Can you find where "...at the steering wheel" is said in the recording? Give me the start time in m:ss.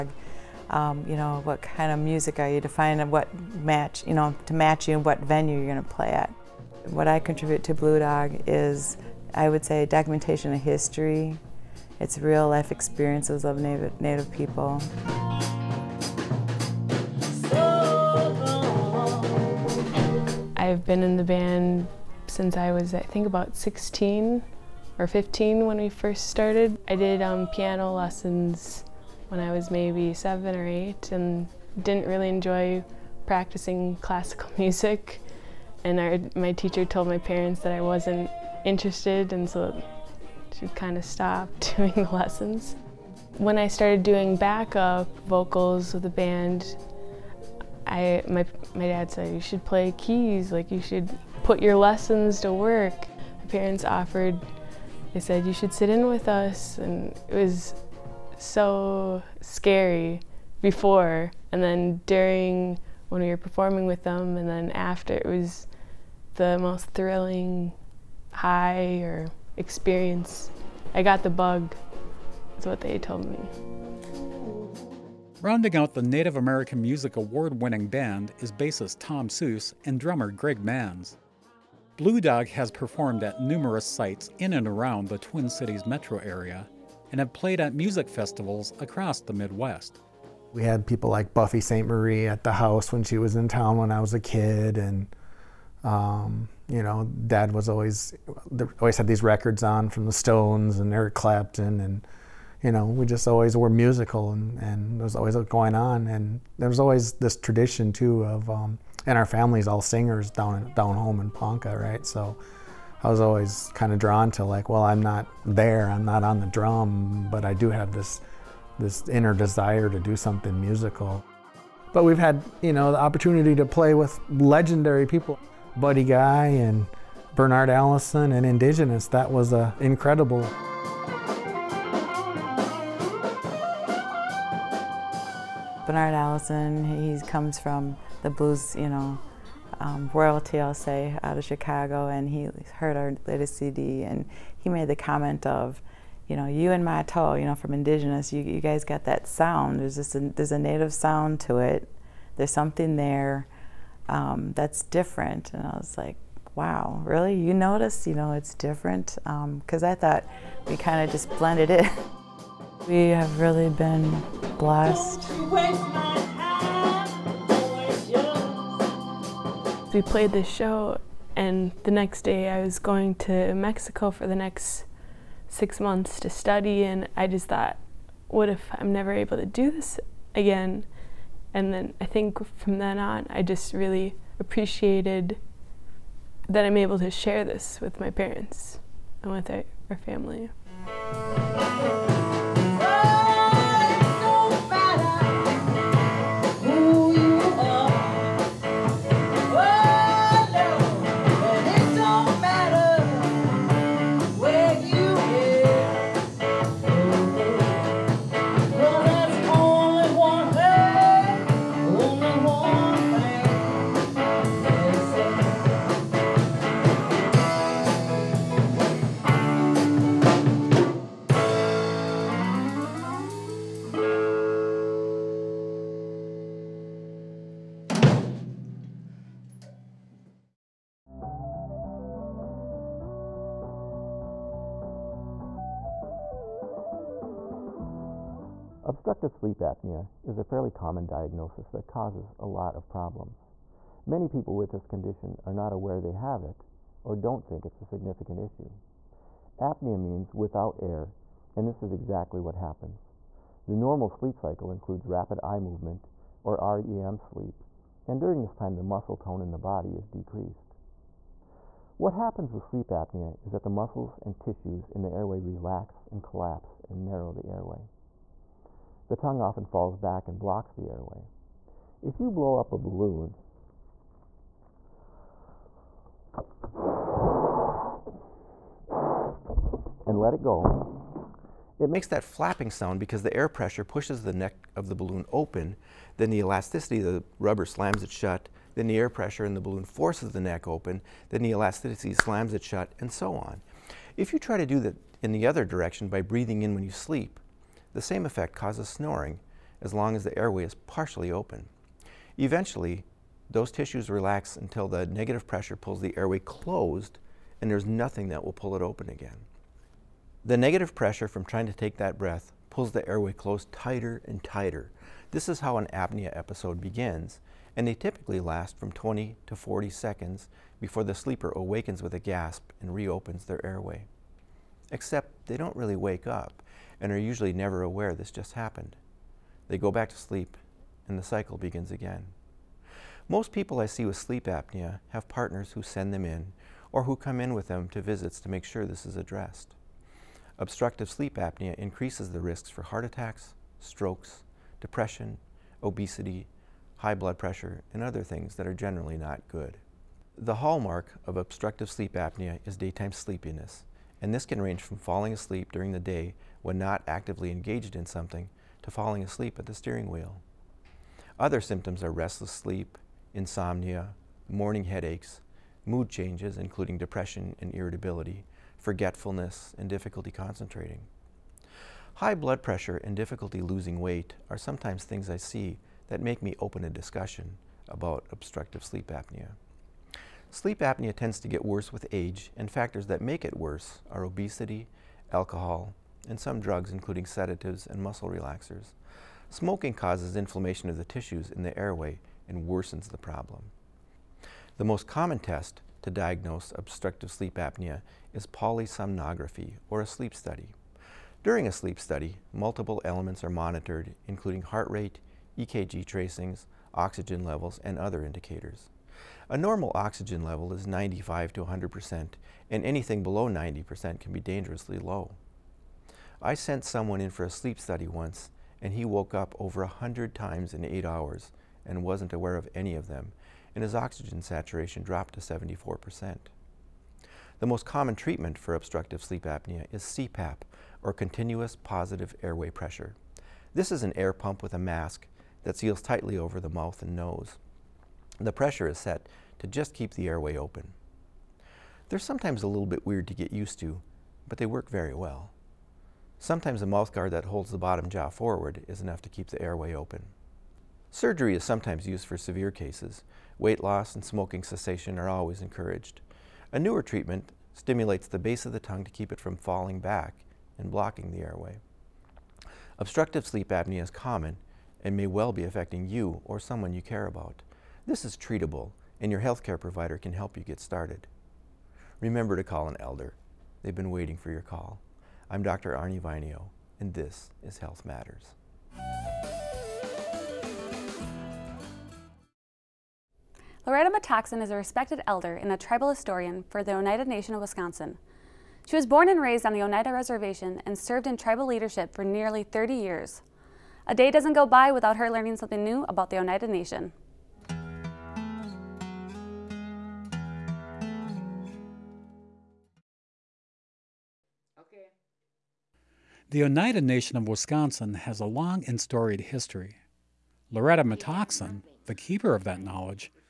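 5:59.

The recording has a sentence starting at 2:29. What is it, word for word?
There's just a, there's a native sound to it.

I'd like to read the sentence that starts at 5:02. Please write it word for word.
Eventually, those tissues relax until the negative pressure pulls the airway closed and there's nothing that will pull it open again.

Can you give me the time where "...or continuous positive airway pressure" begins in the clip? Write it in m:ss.
7:11.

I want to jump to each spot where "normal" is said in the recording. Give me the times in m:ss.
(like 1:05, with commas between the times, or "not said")
4:13, 6:49.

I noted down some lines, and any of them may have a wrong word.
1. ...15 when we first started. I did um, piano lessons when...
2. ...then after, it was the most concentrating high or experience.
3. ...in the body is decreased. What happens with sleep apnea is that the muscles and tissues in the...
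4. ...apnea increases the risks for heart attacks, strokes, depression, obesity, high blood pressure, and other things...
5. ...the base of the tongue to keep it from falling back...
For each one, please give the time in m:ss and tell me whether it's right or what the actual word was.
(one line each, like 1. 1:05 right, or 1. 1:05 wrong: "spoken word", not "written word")
1. 0:25 right
2. 1:04 wrong: "thrilling", not "concentrating"
3. 4:19 right
4. 5:41 right
5. 7:38 right.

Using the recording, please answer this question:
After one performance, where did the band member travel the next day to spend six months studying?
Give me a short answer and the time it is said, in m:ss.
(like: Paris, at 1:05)
Mexico, at 2:53.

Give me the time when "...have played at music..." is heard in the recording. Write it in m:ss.
1:27.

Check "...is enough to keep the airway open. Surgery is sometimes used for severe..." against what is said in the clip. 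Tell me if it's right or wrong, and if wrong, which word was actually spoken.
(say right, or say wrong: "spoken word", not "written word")
right.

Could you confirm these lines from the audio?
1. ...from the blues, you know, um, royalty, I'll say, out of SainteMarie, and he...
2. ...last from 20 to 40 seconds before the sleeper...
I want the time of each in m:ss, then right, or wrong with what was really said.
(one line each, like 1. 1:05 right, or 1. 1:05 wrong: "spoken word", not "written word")
1. 2:17 wrong: "Chicago", not "SainteMarie"
2. 5:18 right.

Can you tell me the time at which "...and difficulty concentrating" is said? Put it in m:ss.
6:09.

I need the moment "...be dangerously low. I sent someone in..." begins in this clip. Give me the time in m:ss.
6:54.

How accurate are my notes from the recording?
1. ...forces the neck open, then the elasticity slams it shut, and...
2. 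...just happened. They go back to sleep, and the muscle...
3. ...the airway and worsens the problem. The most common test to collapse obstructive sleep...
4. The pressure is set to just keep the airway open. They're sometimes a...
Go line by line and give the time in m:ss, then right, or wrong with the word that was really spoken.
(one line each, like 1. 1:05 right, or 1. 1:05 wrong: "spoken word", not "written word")
1. 4:49 right
2. 5:28 wrong: "cycle", not "muscle"
3. 6:31 wrong: "diagnose", not "collapse"
4. 7:18 right.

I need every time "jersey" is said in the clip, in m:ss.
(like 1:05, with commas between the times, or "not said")
not said.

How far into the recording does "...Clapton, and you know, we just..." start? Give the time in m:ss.
1:41.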